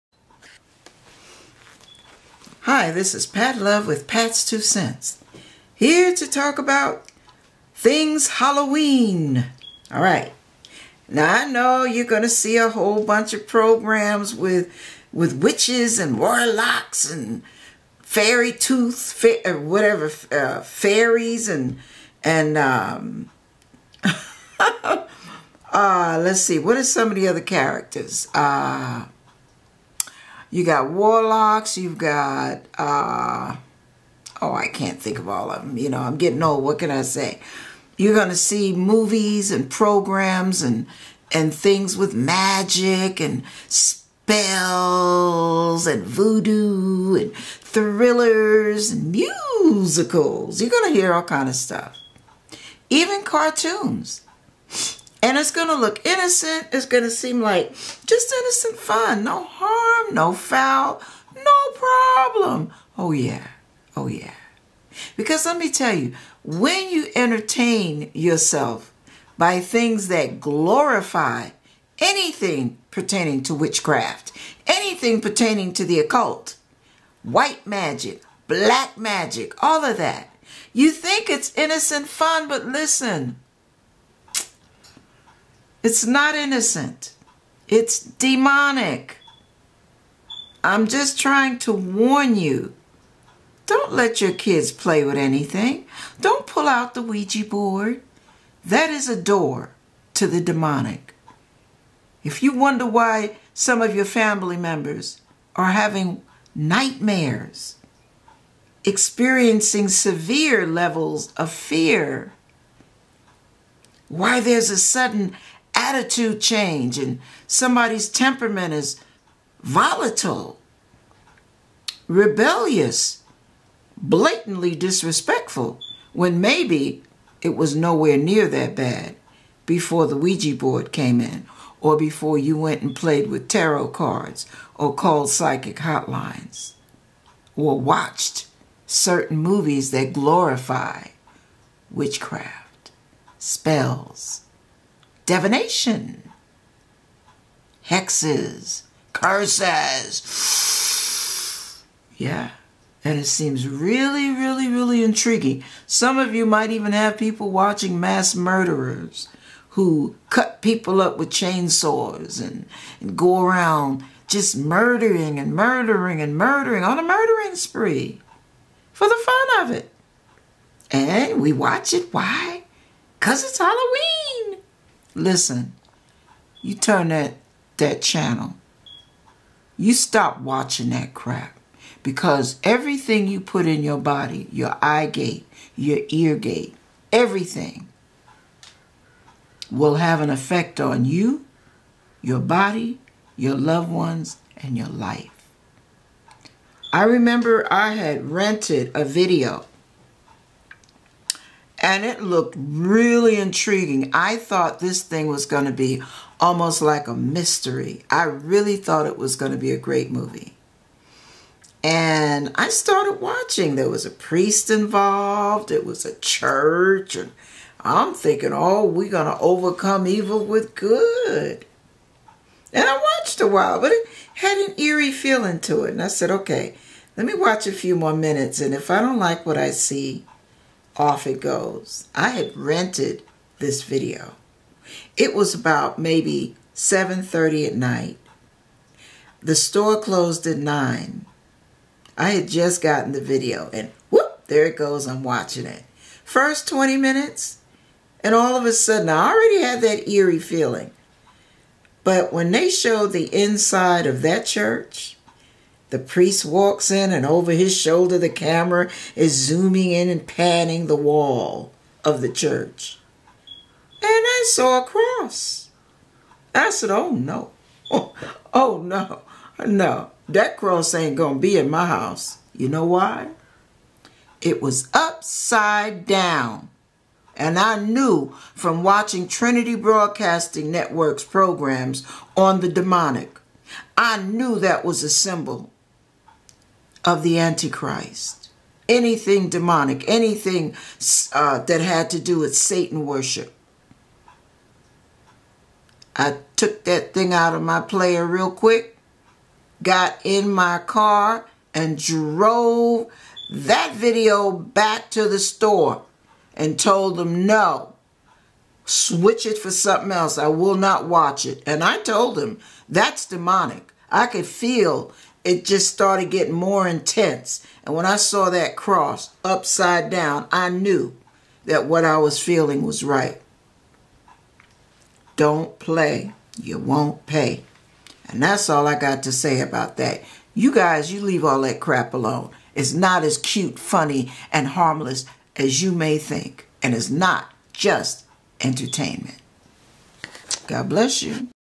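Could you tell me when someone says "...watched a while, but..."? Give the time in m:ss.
3:43.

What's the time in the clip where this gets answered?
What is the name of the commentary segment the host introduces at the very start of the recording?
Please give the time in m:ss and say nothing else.
0:04.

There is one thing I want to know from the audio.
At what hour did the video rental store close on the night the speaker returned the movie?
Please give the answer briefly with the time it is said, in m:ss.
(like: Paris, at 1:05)
9, at 4:00.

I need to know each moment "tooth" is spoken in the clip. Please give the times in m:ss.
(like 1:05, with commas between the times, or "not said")
0:18.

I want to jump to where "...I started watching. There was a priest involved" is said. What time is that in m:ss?
3:32.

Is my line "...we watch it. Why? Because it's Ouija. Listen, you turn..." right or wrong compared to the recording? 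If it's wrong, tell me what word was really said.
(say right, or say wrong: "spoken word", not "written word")
wrong: "Halloween", not "Ouija".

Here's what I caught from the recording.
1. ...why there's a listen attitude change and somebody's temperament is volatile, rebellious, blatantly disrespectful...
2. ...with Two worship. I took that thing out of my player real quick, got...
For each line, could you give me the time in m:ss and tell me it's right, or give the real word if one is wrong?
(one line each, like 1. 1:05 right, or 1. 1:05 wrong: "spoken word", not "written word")
1. 1:54 wrong: "sudden", not "listen"
2. 4:52 wrong: "Satan", not "Two".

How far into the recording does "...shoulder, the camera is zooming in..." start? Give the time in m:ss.
4:17.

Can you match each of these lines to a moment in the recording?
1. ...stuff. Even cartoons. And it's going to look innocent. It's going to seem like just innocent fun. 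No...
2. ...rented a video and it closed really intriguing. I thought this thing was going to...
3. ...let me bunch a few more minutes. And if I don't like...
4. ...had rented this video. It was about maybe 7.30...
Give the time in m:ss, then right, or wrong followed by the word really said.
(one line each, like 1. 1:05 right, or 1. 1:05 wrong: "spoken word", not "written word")
1. 0:51 right
2. 3:18 wrong: "looked", not "closed"
3. 3:47 wrong: "watch", not "bunch"
4. 3:52 right.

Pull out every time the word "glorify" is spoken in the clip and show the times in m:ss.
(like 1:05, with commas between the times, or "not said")
1:10, 2:20.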